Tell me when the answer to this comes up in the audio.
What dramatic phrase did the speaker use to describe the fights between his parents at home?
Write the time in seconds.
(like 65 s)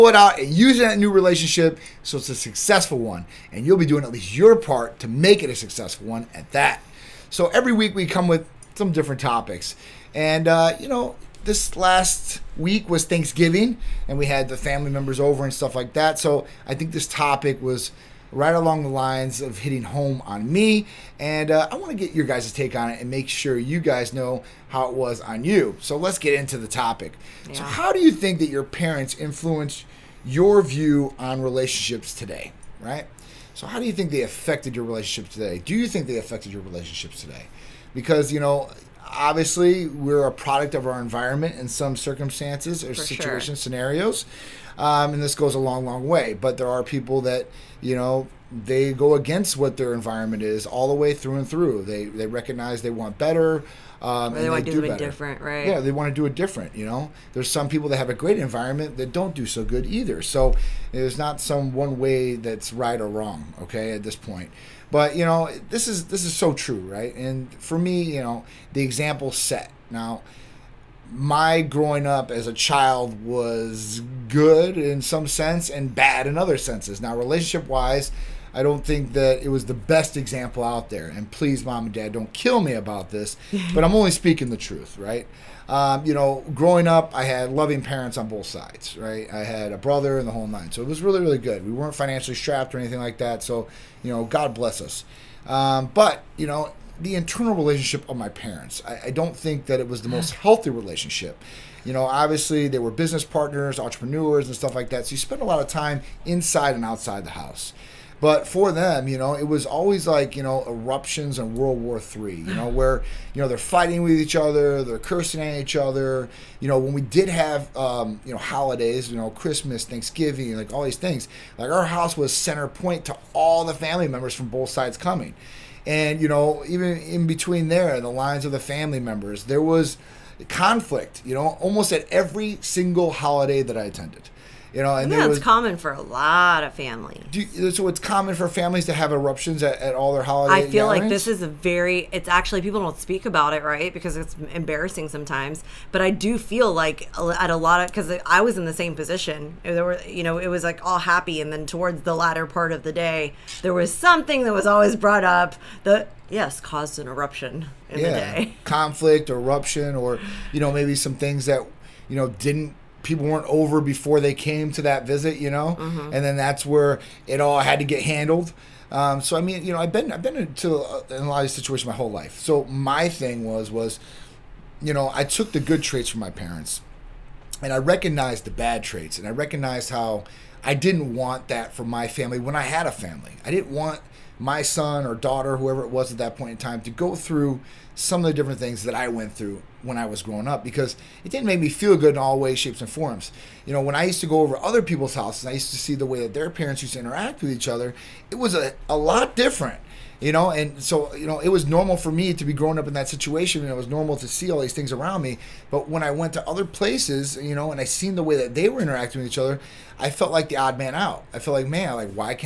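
111 s.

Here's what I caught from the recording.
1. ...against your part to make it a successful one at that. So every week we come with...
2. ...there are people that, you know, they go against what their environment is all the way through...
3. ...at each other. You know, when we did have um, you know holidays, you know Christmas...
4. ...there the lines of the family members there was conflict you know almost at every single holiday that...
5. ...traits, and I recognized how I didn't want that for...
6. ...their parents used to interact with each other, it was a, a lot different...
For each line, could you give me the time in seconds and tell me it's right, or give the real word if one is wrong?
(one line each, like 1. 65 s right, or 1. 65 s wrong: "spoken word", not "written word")
1. 4 s wrong: "least", not "against"
2. 46 s right
3. 115 s right
4. 127 s right
5. 178 s right
6. 196 s right.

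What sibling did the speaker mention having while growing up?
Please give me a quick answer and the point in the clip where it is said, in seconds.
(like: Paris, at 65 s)
a brother, at 89 s.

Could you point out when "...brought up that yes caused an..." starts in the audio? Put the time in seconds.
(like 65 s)
154 s.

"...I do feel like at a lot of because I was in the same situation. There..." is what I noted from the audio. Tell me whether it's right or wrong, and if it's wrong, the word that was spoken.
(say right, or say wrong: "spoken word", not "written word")
wrong: "position", not "situation".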